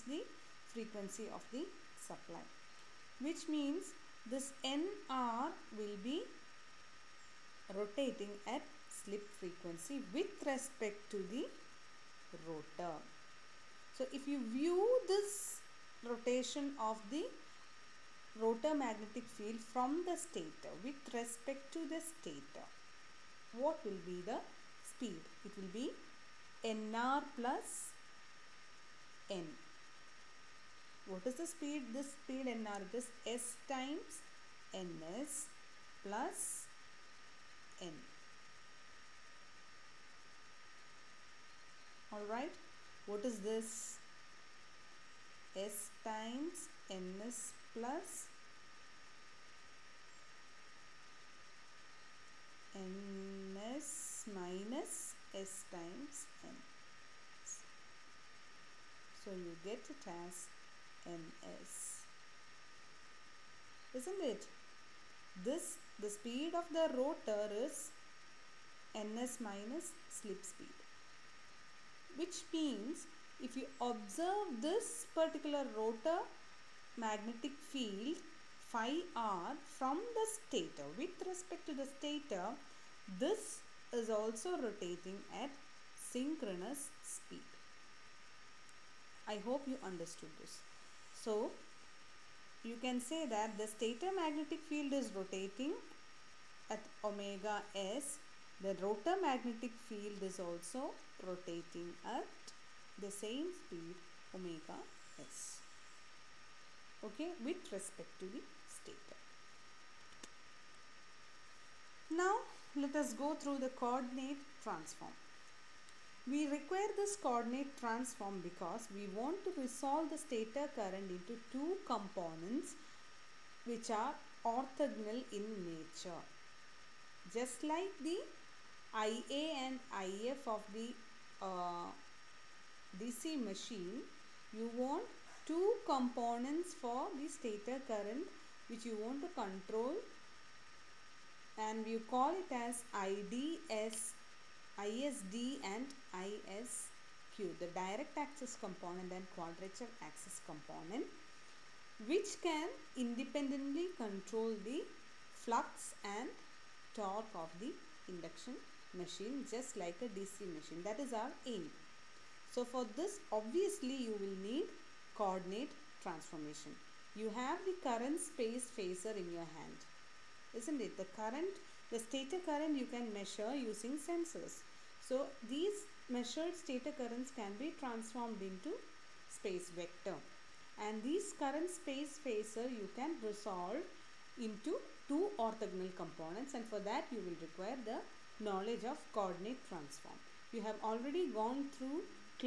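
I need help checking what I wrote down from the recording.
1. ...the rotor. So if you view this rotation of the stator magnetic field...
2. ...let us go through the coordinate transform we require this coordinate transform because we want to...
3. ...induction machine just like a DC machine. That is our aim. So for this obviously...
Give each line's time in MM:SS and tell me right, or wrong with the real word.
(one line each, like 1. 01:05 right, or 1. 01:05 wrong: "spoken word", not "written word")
1. 00:11 wrong: "rotor", not "stator"
2. 01:52 right
3. 02:38 right.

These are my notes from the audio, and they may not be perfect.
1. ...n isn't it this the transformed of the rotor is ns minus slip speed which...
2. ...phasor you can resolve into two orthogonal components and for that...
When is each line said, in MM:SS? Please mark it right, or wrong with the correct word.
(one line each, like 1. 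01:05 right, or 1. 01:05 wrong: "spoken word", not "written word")
1. 01:01 wrong: "speed", not "transformed"
2. 03:02 right.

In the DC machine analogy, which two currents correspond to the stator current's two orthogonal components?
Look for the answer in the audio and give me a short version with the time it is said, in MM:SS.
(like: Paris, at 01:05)
Ia and If, at 02:09.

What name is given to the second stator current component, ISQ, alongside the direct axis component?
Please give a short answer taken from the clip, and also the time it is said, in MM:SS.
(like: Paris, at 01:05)
Quadrature axis component, at 02:29.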